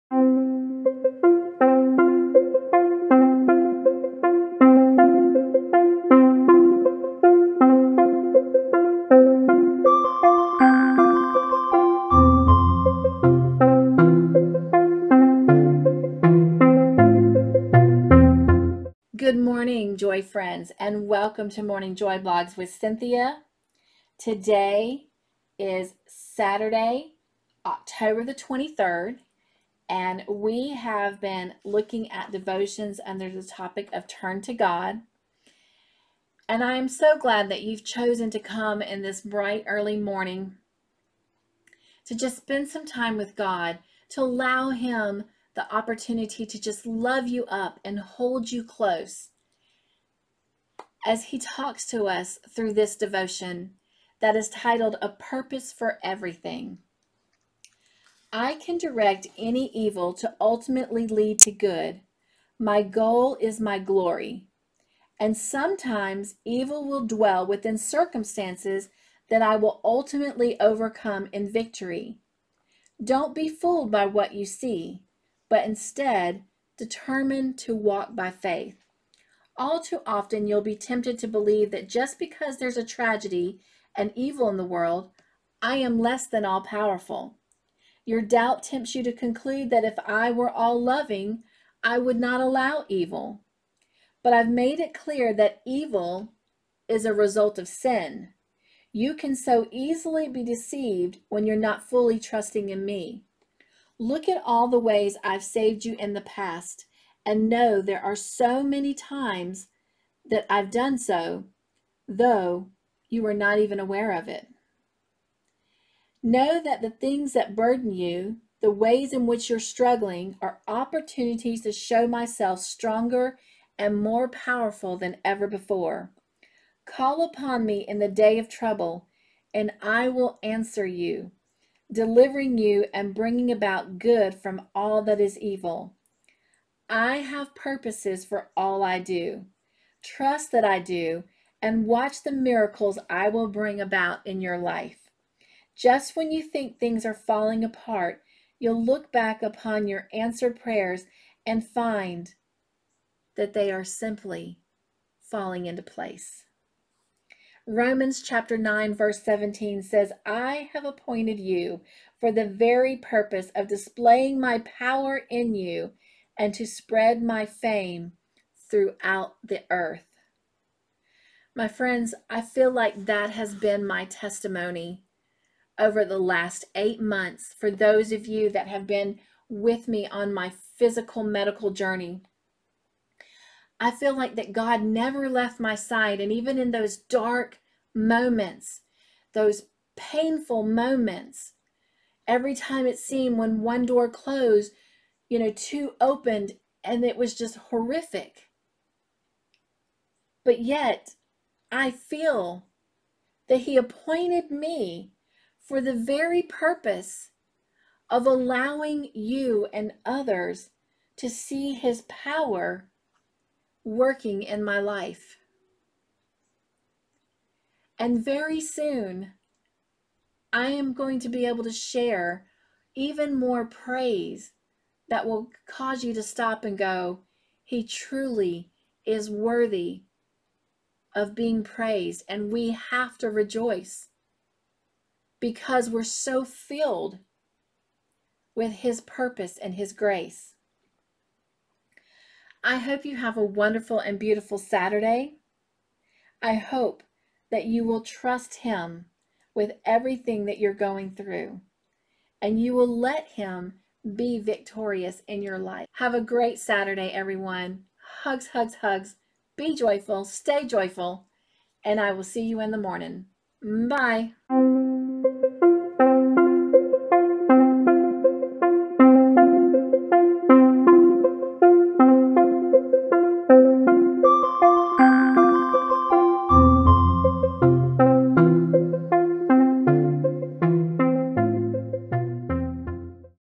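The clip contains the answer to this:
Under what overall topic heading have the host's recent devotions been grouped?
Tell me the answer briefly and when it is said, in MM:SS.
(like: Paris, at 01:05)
Turn to God, at 00:34.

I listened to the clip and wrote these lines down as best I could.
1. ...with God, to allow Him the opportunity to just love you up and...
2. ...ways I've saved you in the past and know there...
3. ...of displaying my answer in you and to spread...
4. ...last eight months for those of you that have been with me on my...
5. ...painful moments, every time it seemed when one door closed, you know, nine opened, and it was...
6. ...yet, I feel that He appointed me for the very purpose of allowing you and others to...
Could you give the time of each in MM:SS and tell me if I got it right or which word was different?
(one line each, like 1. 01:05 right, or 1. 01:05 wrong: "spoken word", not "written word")
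1. 00:43 right
2. 01:44 right
3. 02:43 wrong: "power", not "answer"
4. 02:56 right
5. 03:09 wrong: "two", not "nine"
6. 03:20 right.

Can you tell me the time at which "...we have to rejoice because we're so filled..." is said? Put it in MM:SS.
03:52.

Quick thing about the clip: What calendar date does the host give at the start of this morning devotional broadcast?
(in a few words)
October 23.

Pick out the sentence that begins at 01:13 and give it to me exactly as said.
Don't be fooled by what you see, but instead determine to walk by faith.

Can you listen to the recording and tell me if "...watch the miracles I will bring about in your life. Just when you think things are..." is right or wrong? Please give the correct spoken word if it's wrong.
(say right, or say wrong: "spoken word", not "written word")
right.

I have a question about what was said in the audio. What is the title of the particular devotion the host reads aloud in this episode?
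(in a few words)
A Purpose for Everything.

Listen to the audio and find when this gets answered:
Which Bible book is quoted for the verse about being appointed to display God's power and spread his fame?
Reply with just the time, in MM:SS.
02:37.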